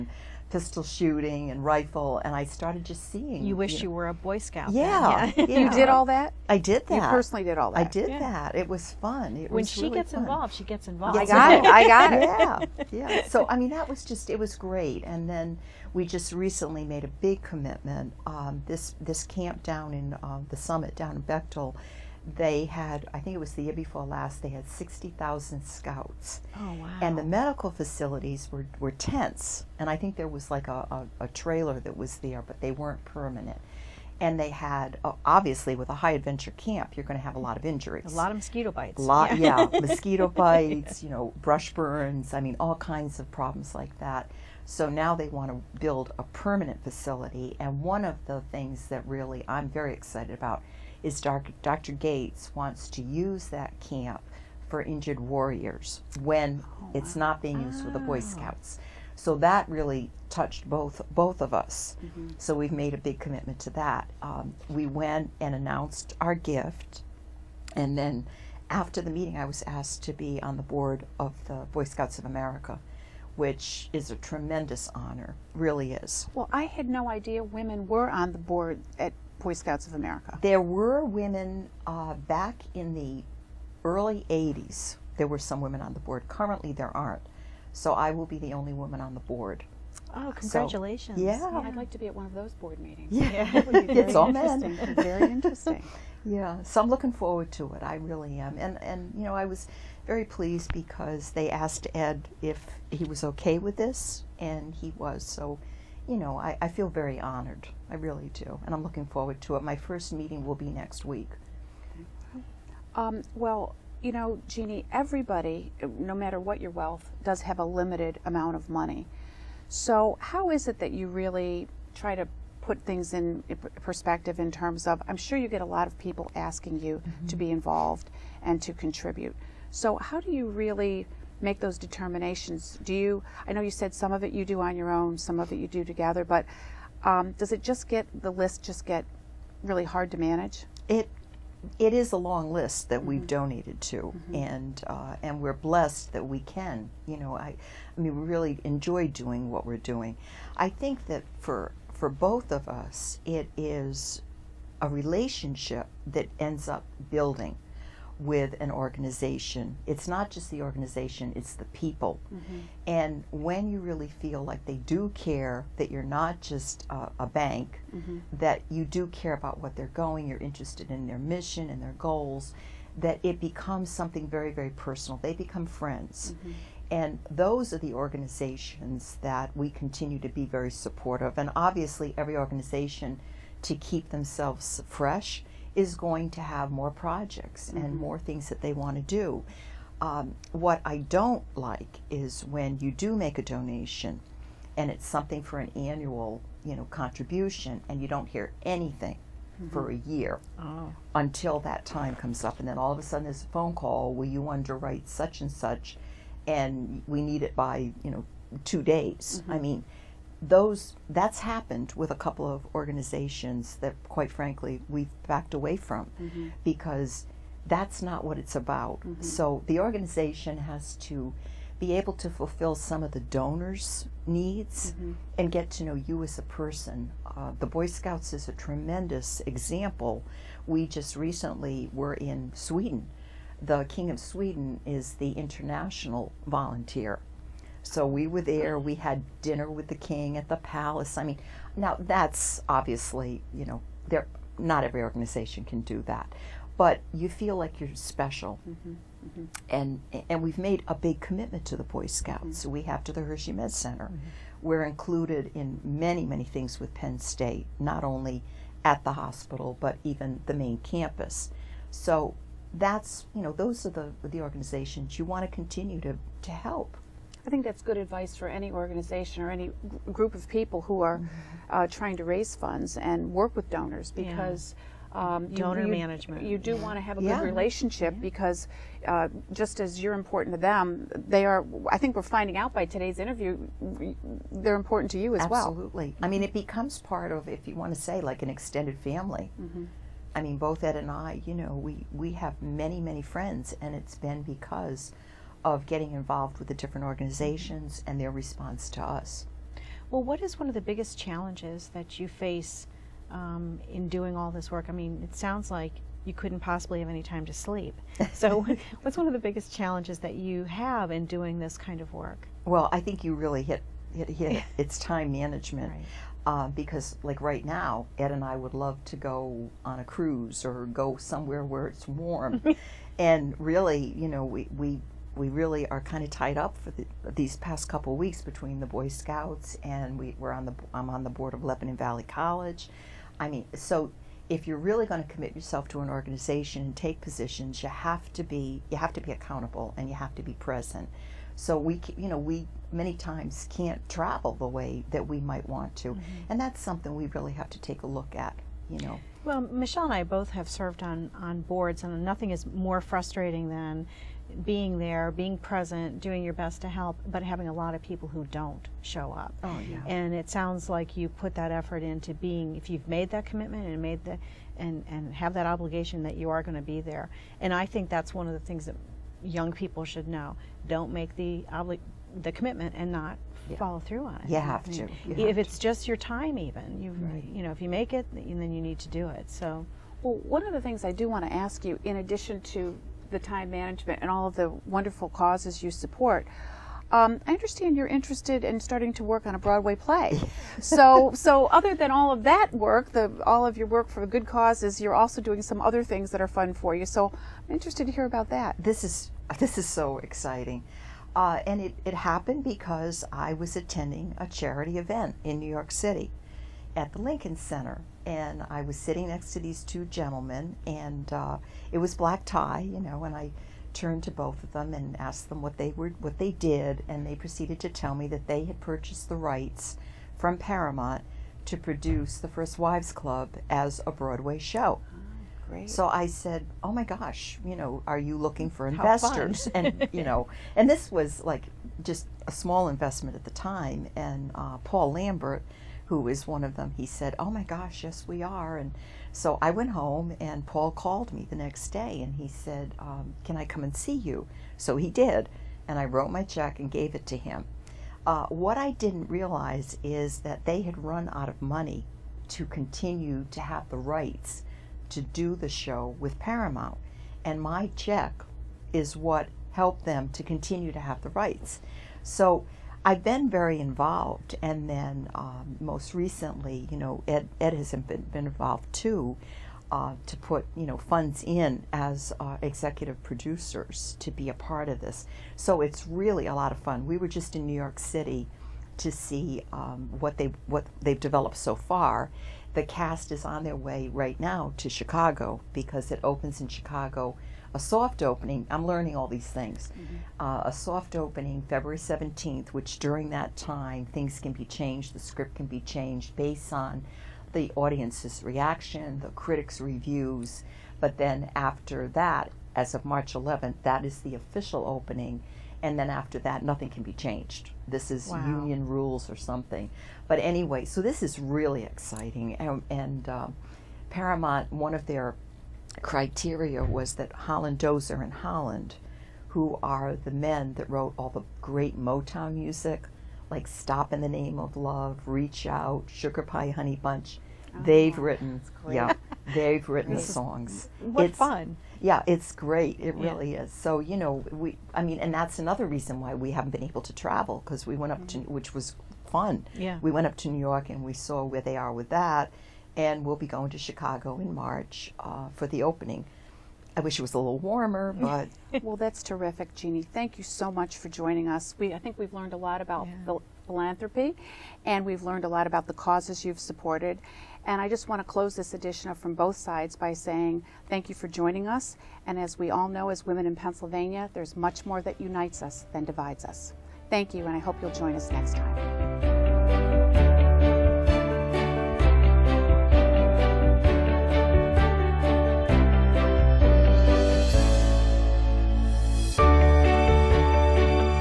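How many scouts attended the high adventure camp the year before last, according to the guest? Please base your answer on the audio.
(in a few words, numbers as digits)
60,000.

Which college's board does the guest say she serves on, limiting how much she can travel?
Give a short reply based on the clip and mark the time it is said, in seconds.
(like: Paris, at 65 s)
Lebanon Valley College, at 331 s.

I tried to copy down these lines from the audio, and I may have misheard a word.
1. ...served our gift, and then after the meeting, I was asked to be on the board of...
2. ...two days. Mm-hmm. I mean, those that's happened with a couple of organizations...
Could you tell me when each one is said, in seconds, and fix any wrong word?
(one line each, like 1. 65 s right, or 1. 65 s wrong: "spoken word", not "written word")
1. 65 s wrong: "announced", not "served"
2. 208 s right.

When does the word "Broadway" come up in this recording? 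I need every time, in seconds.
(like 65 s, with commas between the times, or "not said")
389 s, 424 s.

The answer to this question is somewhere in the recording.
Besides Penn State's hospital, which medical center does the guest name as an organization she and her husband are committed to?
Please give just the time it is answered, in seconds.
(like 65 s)
253 s.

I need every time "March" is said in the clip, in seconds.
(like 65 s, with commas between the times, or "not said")
503 s, 544 s.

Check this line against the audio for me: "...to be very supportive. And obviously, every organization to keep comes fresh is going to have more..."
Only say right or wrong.
wrong.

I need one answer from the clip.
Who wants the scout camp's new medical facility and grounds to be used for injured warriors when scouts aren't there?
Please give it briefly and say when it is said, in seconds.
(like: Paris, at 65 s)
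Dr. Gates, at 51 s.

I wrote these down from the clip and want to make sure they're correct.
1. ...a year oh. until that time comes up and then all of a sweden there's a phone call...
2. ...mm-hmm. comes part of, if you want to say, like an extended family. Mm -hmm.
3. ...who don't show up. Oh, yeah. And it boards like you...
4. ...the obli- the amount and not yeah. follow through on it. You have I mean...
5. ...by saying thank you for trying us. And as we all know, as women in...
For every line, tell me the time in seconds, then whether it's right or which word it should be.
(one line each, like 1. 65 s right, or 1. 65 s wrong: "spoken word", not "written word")
1. 199 s wrong: "sudden", not "sweden"
2. 286 s wrong: "becomes", not "comes"
3. 358 s wrong: "sounds", not "boards"
4. 371 s wrong: "commitment", not "amount"
5. 559 s wrong: "joining", not "trying".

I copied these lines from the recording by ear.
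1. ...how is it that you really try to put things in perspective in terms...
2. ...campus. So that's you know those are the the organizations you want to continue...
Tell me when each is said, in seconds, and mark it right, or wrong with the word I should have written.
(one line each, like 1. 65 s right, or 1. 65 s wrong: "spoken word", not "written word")
1. 120 s right
2. 260 s right.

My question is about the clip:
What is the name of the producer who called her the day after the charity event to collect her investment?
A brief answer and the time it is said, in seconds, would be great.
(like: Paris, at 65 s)
Paul Lambert, at 434 s.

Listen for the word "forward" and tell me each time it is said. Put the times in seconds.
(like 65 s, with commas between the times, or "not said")
97 s, 109 s.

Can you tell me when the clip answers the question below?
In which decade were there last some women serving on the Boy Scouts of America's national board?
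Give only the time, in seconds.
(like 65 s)
83 s.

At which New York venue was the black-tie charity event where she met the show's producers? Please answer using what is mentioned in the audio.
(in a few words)
Lincoln Center.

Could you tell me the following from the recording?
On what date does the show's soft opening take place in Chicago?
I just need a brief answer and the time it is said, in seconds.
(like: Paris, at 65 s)
February 17, at 491 s.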